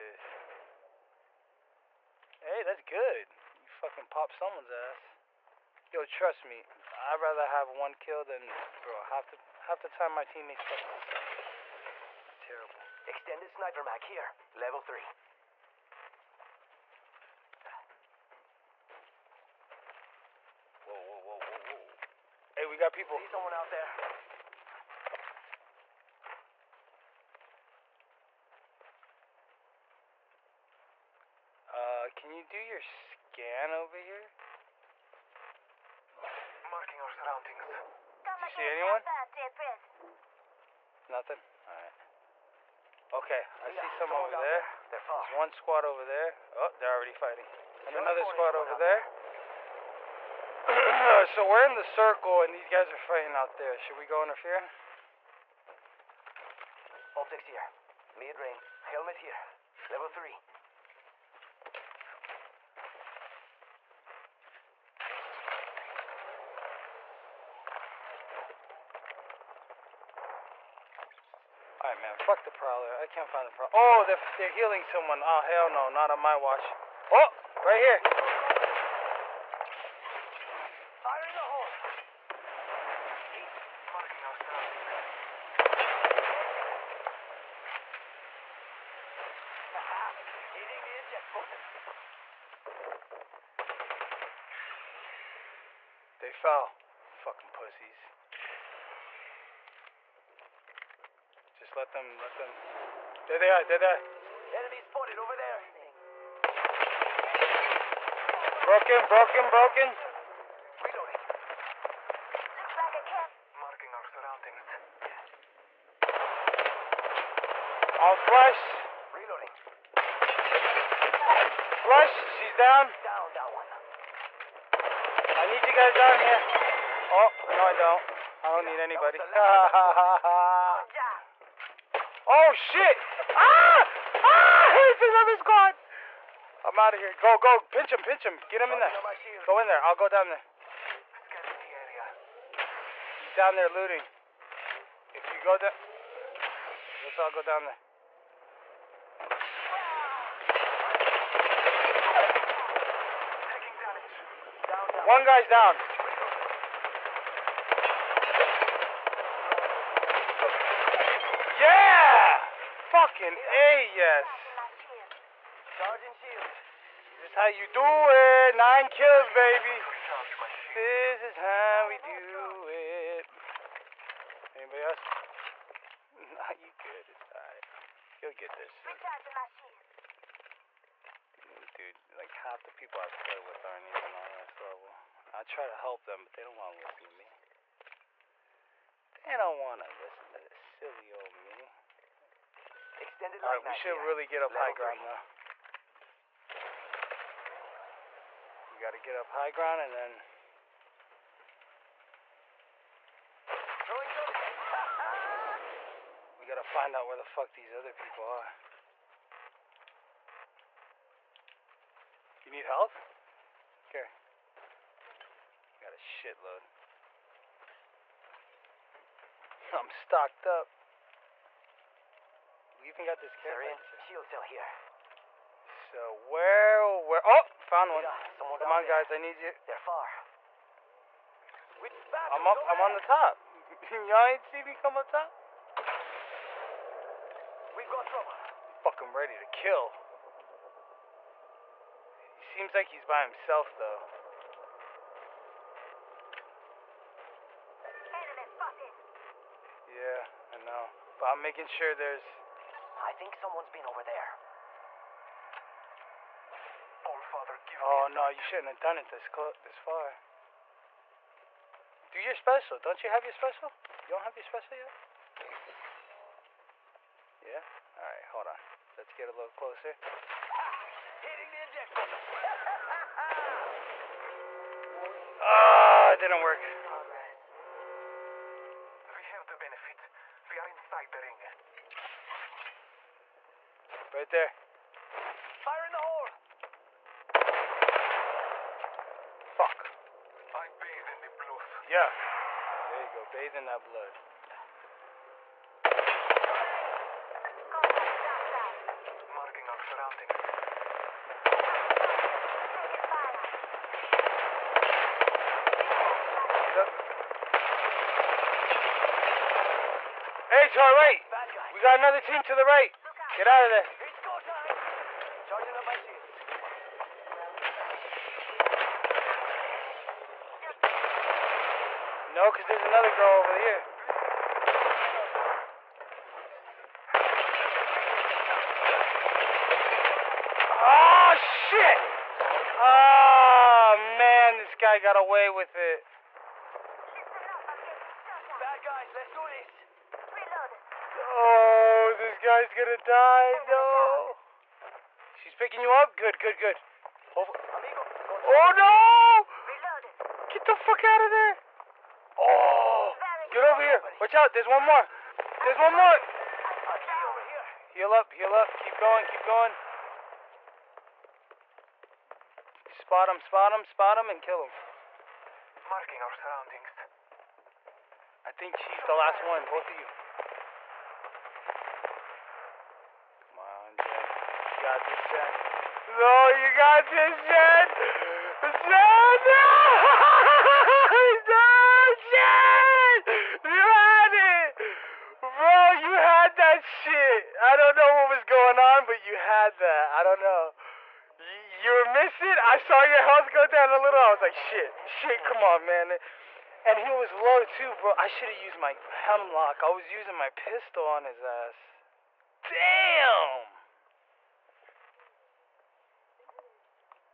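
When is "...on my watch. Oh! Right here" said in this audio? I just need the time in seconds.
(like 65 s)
76 s.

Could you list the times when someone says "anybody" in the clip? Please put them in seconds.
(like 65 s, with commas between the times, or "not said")
128 s, 174 s.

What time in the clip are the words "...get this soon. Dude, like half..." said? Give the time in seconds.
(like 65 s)
178 s.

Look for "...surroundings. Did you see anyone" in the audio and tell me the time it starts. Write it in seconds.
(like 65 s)
37 s.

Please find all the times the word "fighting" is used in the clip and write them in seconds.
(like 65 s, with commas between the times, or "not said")
47 s, 52 s.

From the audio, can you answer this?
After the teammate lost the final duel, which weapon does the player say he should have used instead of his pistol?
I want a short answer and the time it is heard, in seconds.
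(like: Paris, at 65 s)
Hemlok, at 399 s.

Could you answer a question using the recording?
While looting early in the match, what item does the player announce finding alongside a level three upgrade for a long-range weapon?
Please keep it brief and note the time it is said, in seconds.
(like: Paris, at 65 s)
Extended sniper mag, at 13 s.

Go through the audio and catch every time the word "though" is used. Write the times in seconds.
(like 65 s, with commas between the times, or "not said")
196 s, 243 s.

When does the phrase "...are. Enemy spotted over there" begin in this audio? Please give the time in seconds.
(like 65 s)
103 s.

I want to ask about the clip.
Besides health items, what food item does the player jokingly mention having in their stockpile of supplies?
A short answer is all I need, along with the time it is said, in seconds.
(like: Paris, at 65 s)
Carrot, at 223 s.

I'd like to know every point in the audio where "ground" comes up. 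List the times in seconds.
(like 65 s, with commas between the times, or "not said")
194 s, 199 s.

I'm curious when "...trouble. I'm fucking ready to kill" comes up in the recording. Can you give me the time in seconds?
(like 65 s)
238 s.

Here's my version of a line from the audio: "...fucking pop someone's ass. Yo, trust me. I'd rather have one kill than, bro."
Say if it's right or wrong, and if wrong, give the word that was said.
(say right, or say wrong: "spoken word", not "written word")
right.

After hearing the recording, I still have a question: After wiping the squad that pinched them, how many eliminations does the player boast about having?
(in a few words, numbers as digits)
9.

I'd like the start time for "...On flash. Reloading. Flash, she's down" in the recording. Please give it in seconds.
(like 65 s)
118 s.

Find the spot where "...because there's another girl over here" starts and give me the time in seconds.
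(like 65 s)
322 s.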